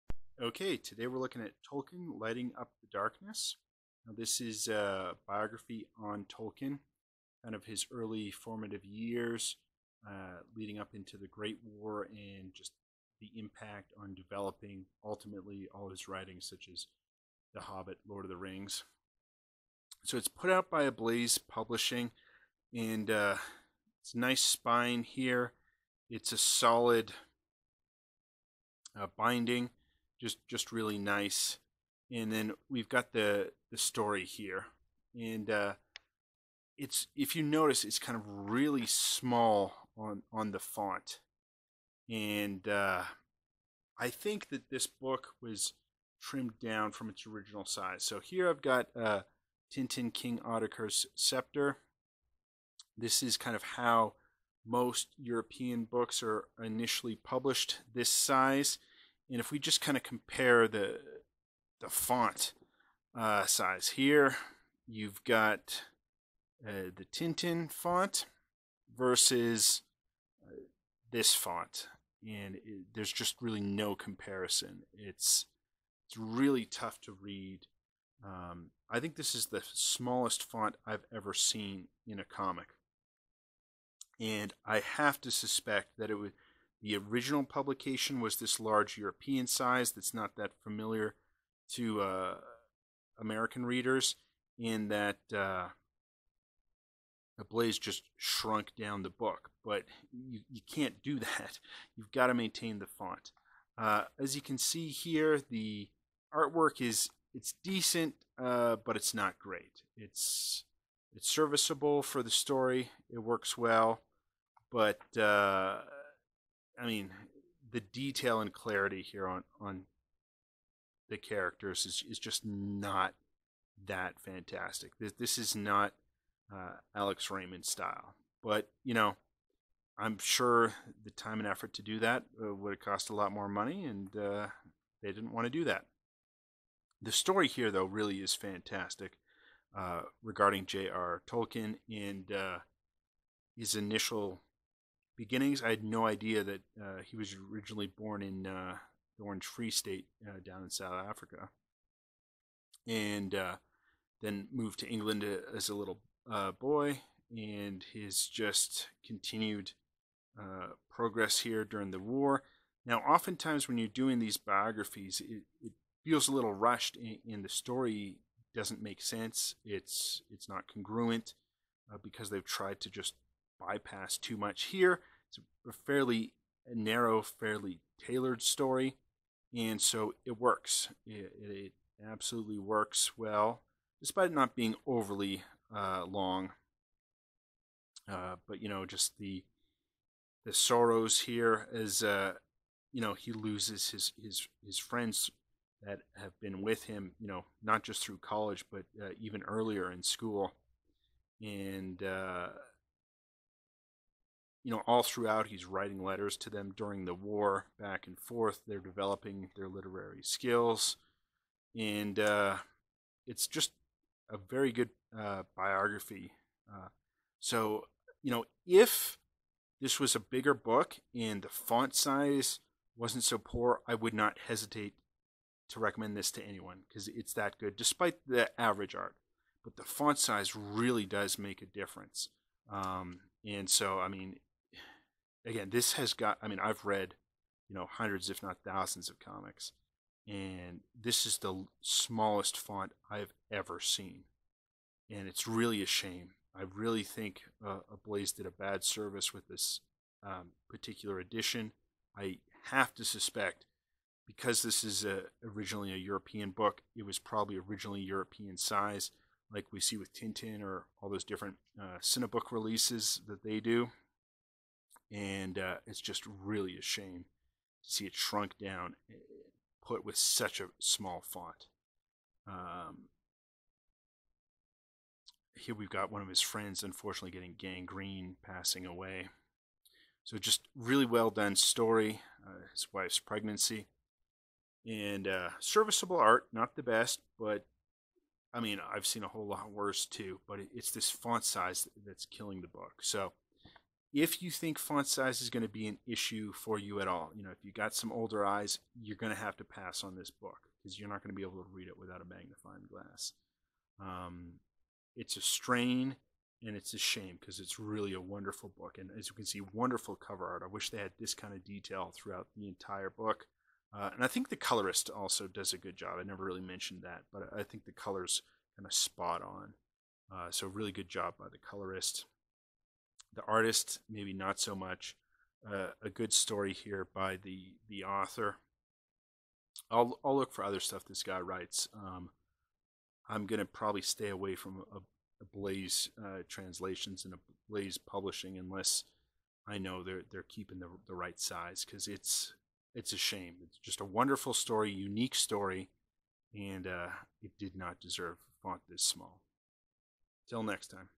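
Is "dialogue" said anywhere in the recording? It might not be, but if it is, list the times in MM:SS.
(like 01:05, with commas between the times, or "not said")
not said.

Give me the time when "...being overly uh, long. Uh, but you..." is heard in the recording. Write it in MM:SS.
03:04.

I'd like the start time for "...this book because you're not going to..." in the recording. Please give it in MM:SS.
05:00.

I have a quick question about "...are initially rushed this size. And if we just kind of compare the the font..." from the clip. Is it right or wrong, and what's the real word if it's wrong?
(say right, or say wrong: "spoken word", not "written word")
wrong: "published", not "rushed".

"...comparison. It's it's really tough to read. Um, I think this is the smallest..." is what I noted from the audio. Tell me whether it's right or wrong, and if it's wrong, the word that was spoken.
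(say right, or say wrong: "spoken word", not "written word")
right.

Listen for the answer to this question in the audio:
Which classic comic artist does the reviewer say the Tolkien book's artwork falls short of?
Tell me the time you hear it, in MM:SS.
02:06.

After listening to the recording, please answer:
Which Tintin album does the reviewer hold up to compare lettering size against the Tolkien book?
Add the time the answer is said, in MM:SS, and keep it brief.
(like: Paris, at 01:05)
King Ottokar's Scepter, at 00:50.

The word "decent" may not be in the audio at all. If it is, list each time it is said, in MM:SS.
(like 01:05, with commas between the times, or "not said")
01:47.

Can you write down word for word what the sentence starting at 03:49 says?
But the font size really does make a difference.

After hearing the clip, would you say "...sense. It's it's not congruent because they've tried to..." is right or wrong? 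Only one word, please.
right.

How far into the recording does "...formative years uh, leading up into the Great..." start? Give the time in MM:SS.
00:08.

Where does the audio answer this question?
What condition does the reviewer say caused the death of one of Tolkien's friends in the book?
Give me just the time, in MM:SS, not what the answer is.
04:37.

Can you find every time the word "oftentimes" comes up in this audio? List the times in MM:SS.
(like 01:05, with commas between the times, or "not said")
02:43.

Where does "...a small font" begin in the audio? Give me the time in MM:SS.
04:30.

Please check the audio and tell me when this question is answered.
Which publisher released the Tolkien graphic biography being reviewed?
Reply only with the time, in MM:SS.
00:20.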